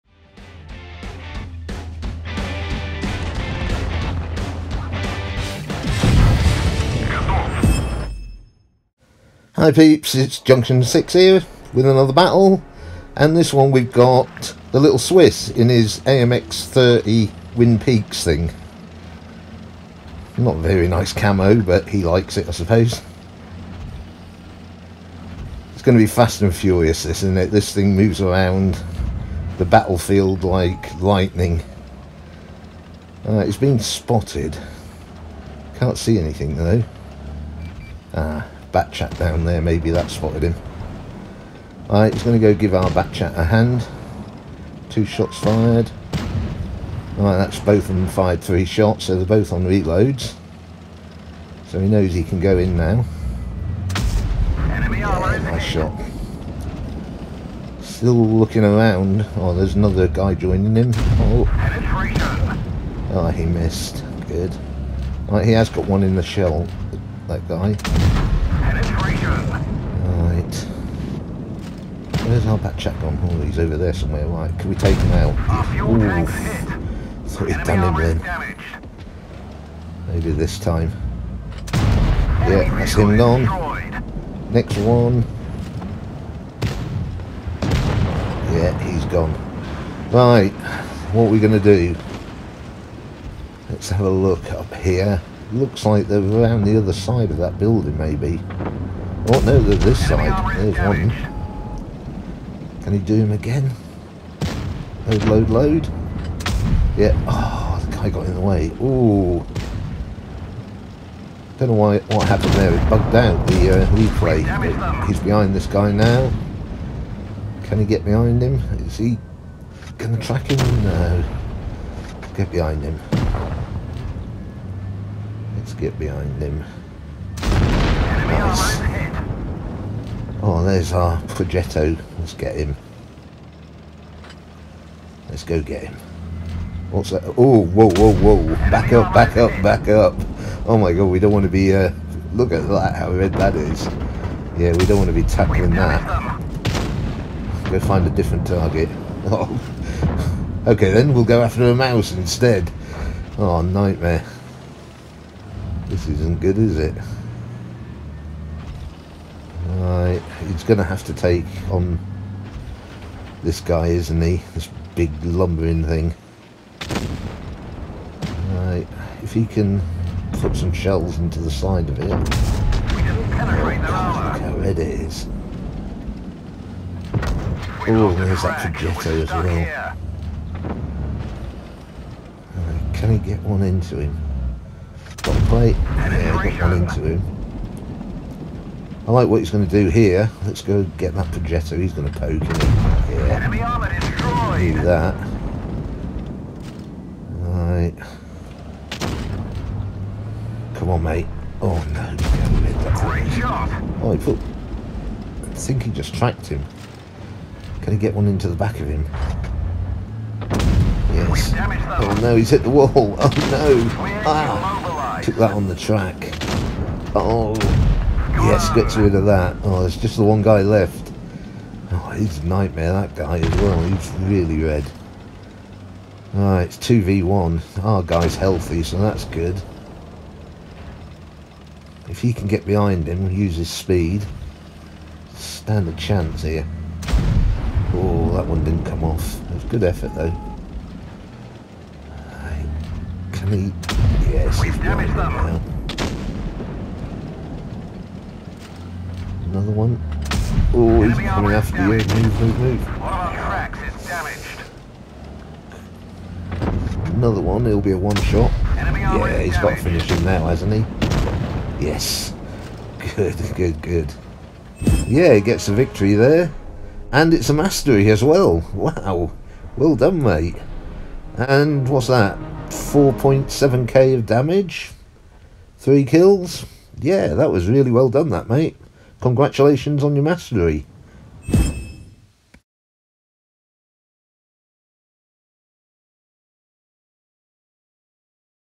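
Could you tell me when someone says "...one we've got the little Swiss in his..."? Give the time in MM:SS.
00:13.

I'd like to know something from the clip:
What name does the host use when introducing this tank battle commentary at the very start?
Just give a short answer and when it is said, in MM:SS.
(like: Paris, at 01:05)
Junction 6, at 00:10.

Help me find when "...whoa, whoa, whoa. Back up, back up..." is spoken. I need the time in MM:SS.
02:17.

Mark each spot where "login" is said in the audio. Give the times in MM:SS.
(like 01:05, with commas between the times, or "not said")
not said.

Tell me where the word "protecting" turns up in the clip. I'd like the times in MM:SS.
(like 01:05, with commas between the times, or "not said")
not said.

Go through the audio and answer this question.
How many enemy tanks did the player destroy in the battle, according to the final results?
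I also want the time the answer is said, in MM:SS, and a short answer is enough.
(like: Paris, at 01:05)
3, at 04:35.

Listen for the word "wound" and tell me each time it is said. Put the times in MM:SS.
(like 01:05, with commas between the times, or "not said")
not said.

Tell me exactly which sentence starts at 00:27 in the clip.
This thing moves around the battlefield like lightning.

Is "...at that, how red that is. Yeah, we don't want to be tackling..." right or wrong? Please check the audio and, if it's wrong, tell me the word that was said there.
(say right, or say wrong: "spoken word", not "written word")
right.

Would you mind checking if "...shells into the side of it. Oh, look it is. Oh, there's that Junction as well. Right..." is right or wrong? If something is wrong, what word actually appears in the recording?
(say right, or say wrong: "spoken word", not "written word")
wrong: "Progetto", not "Junction".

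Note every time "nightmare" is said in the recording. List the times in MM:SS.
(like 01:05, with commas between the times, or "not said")
02:33, 03:42.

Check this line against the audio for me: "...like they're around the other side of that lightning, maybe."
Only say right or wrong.
wrong.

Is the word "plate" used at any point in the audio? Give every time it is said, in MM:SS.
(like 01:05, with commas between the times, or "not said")
03:05.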